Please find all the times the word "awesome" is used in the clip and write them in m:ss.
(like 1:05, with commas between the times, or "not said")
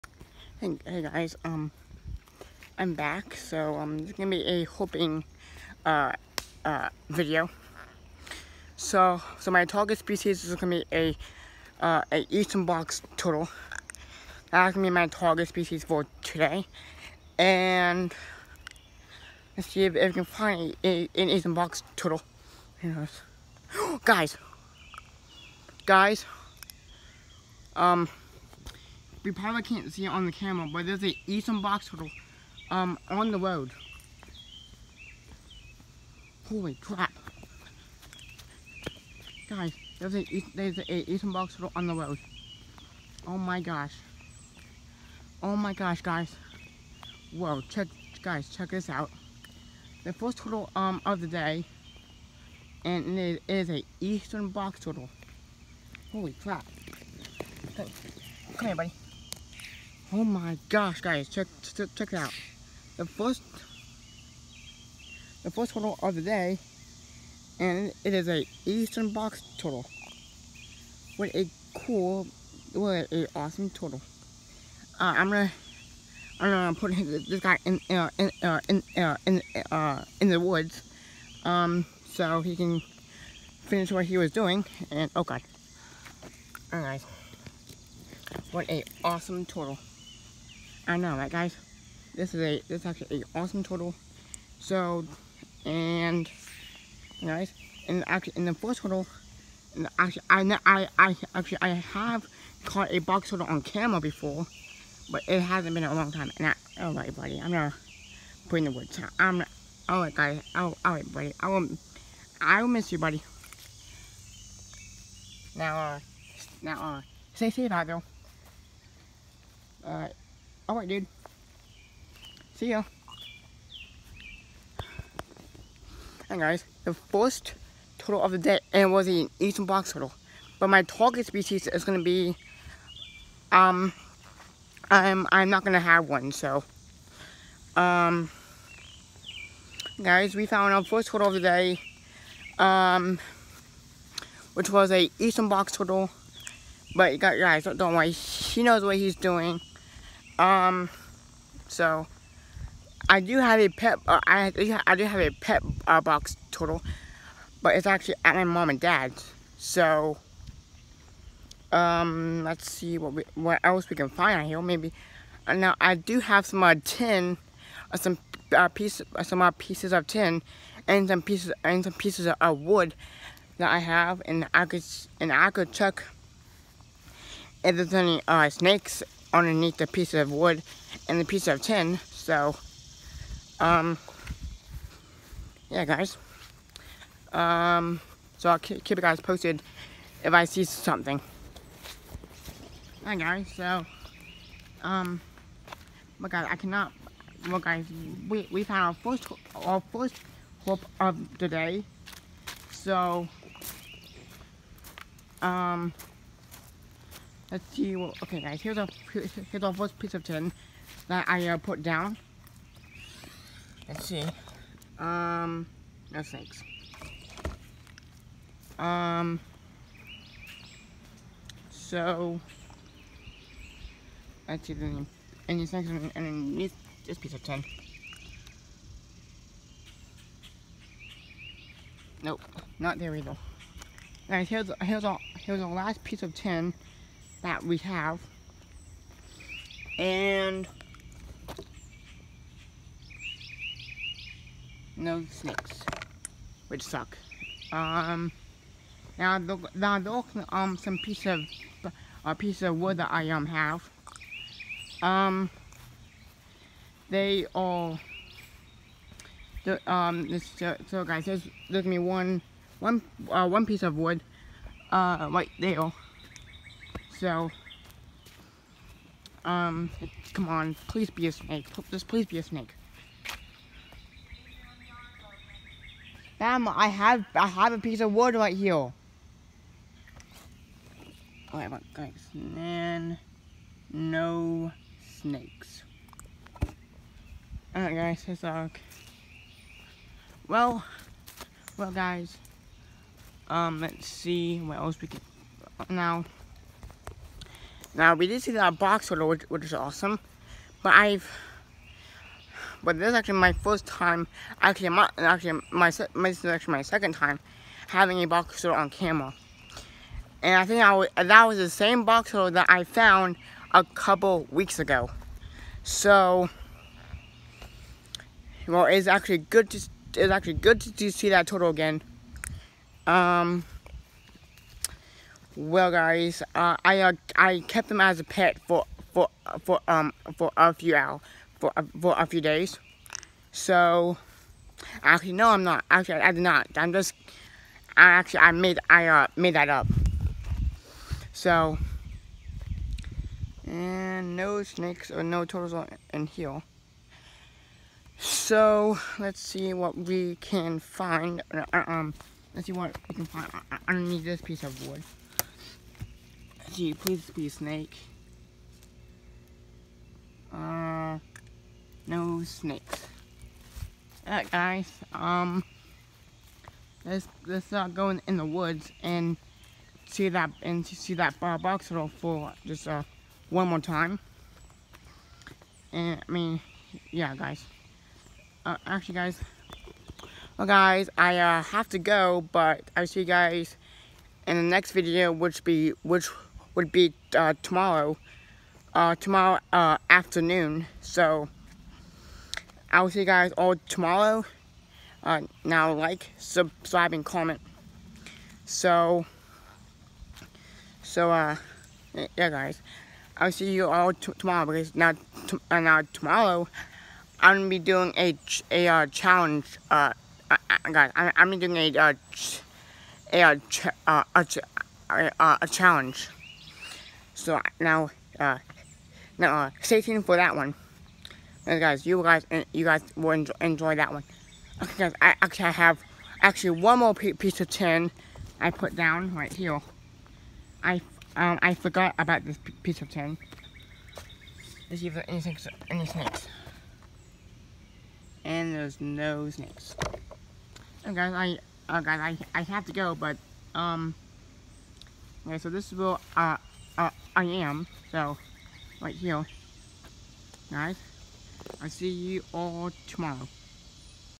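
1:13, 1:29, 1:33, 4:59.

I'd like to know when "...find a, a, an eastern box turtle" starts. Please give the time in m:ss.
0:20.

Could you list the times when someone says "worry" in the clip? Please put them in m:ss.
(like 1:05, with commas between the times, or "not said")
2:27.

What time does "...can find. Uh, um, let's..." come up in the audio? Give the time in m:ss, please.
5:50.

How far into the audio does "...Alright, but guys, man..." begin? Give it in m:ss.
4:41.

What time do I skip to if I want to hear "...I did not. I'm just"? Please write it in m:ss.
5:36.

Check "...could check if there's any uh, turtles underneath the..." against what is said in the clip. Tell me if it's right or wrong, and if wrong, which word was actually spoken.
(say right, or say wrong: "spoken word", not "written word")
wrong: "snakes", not "turtles".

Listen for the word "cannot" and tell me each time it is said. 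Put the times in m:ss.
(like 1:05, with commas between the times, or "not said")
3:16.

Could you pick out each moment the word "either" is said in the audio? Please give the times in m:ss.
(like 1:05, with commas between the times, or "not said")
3:53.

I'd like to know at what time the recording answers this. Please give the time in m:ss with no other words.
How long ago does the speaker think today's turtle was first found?
5:13.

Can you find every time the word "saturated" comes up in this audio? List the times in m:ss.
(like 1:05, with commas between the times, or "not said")
not said.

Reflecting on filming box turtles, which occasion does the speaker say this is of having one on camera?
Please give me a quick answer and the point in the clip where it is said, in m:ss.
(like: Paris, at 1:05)
Second time, at 5:06.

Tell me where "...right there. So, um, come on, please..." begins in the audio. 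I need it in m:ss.
4:25.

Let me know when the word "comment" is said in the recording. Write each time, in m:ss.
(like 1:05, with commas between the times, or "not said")
6:37.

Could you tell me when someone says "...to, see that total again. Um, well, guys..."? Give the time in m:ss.
5:20.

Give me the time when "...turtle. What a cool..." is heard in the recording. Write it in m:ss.
1:09.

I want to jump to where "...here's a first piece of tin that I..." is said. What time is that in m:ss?
3:29.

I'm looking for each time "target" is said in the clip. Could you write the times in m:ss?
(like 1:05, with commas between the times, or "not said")
0:09, 0:15, 2:10.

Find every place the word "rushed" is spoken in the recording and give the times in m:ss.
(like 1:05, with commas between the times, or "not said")
not said.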